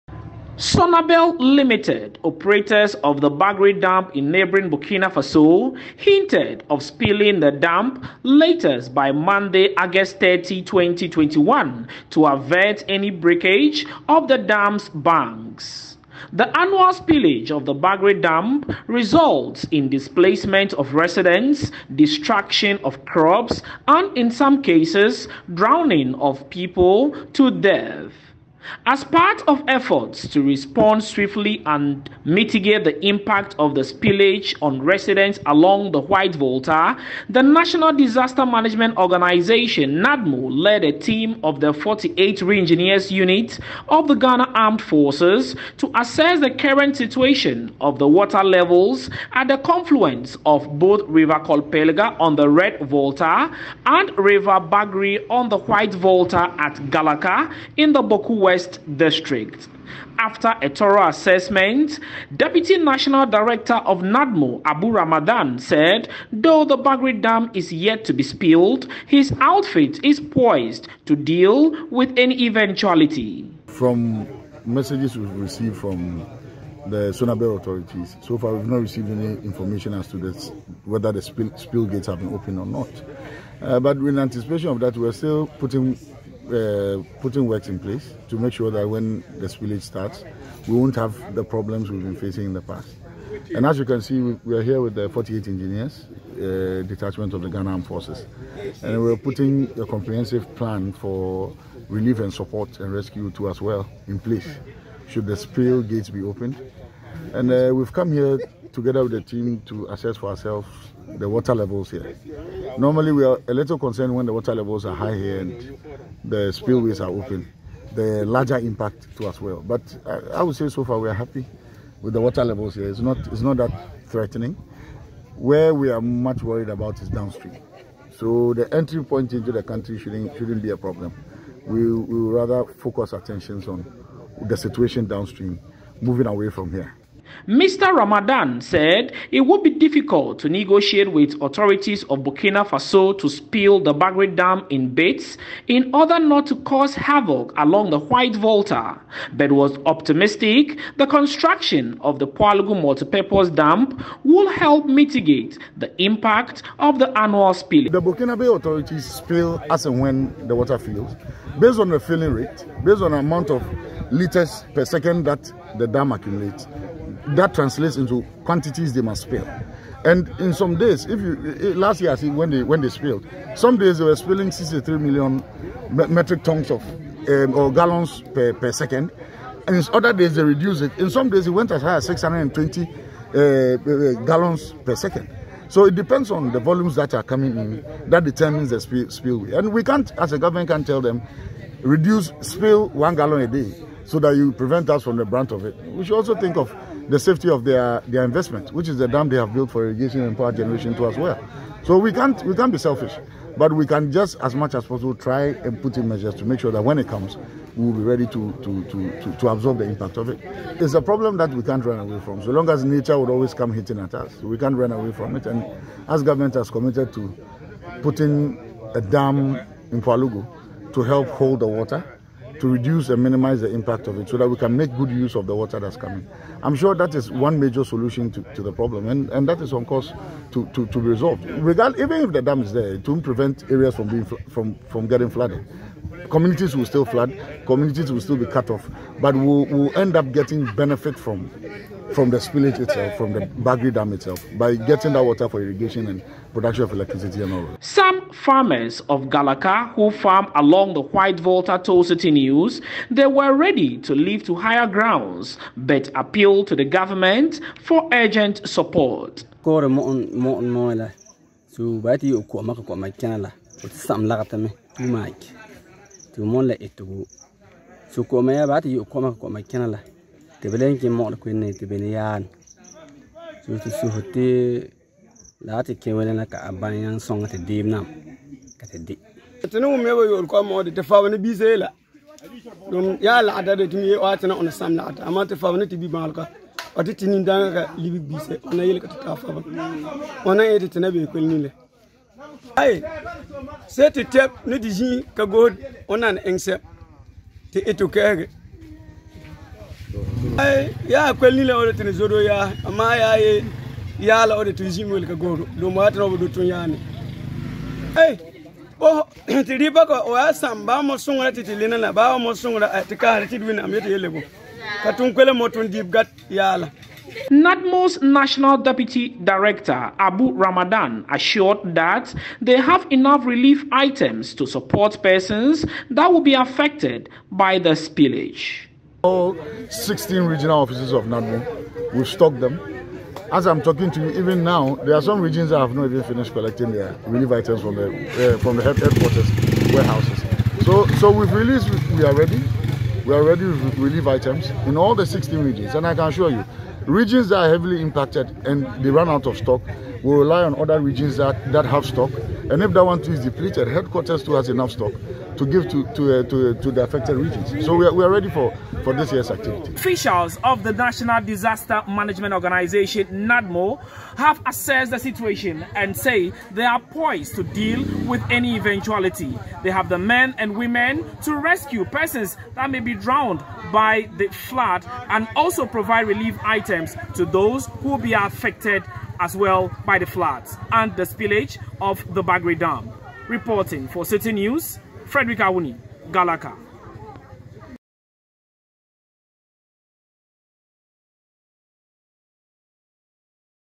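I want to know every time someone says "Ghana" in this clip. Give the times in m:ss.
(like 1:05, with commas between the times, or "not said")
0:44, 1:37.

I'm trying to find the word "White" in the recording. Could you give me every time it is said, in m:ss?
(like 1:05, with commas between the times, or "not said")
0:35, 0:55, 2:27, 4:11.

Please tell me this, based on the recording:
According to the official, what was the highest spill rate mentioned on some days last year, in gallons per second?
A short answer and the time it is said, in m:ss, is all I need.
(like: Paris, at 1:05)
620, at 3:02.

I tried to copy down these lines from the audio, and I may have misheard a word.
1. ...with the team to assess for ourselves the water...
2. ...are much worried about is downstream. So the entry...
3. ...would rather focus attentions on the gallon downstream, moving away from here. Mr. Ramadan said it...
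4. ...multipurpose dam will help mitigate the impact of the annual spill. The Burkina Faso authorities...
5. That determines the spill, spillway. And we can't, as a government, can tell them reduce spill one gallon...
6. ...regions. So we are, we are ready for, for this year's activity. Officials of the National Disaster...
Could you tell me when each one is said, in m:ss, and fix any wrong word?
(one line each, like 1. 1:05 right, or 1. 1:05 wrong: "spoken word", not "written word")
1. 1:49 right
2. 2:05 right
3. 2:12 wrong: "situation", not "gallon"
4. 2:32 right
5. 3:08 right
6. 5:57 right.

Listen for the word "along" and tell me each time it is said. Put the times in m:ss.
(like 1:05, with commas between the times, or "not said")
0:35, 2:27, 4:10.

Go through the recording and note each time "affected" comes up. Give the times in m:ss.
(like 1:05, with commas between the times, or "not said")
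5:26, 5:57, 6:18.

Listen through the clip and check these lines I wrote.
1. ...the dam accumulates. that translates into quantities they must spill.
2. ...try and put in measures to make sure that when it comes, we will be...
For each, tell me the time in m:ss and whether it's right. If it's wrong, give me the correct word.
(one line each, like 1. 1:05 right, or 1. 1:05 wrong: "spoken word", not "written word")
1. 2:45 right
2. 3:25 right.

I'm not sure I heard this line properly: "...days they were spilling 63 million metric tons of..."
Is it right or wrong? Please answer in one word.
right.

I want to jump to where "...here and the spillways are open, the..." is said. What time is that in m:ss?
1:55.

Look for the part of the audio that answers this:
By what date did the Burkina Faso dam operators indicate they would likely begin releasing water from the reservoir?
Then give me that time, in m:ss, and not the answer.
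0:09.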